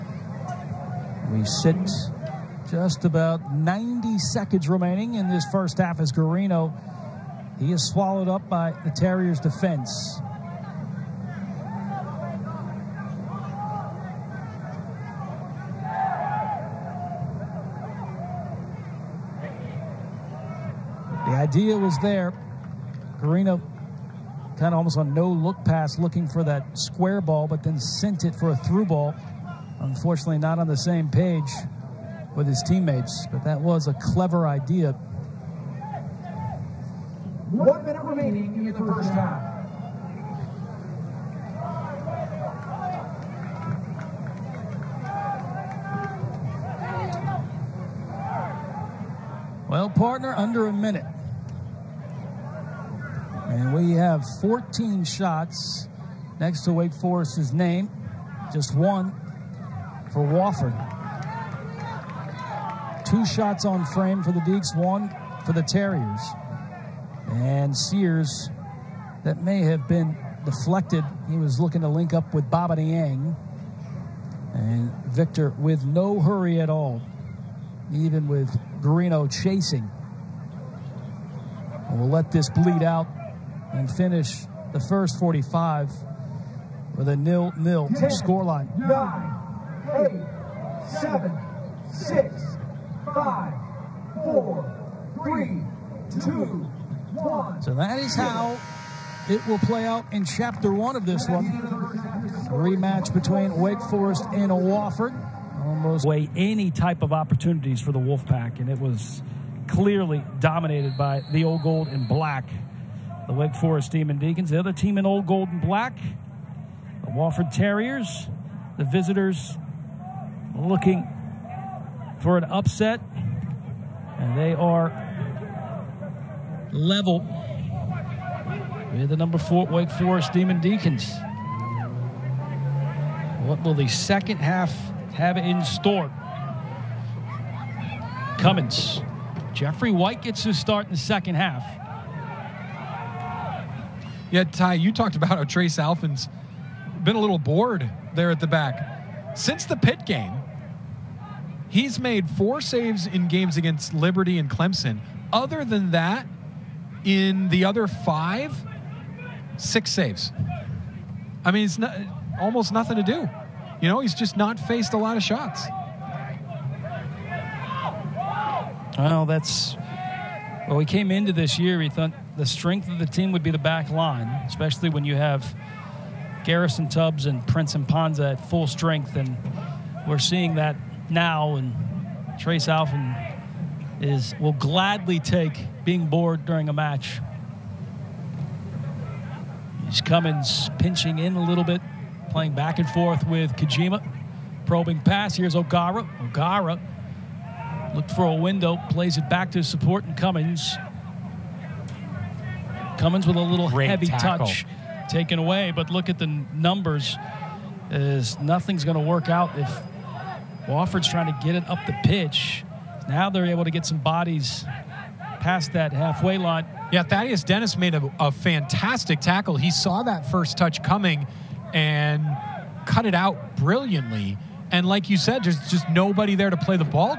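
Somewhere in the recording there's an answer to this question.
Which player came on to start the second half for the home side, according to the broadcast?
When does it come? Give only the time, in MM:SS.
02:19.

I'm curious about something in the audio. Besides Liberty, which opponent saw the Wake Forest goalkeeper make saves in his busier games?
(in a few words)
Clemson.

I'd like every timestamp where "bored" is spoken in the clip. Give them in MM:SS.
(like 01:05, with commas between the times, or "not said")
02:27, 03:06.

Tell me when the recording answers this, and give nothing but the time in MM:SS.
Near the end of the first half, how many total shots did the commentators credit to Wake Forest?
00:54.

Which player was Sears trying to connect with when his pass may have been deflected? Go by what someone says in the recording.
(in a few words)
Baba Niang.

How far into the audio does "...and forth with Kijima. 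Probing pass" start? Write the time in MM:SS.
03:12.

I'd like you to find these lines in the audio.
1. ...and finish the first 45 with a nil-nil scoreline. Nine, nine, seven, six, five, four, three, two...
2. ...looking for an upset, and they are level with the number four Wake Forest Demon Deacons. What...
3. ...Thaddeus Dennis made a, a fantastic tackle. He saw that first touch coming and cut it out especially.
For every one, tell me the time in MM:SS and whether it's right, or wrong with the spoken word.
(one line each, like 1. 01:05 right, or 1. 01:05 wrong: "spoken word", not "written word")
1. 01:23 wrong: "eight", not "nine"
2. 02:00 right
3. 03:37 wrong: "brilliantly", not "especially".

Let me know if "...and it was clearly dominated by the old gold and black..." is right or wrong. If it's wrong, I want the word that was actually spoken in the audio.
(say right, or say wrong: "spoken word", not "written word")
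right.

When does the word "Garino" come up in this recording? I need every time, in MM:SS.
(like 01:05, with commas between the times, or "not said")
00:06, 00:23, 01:18.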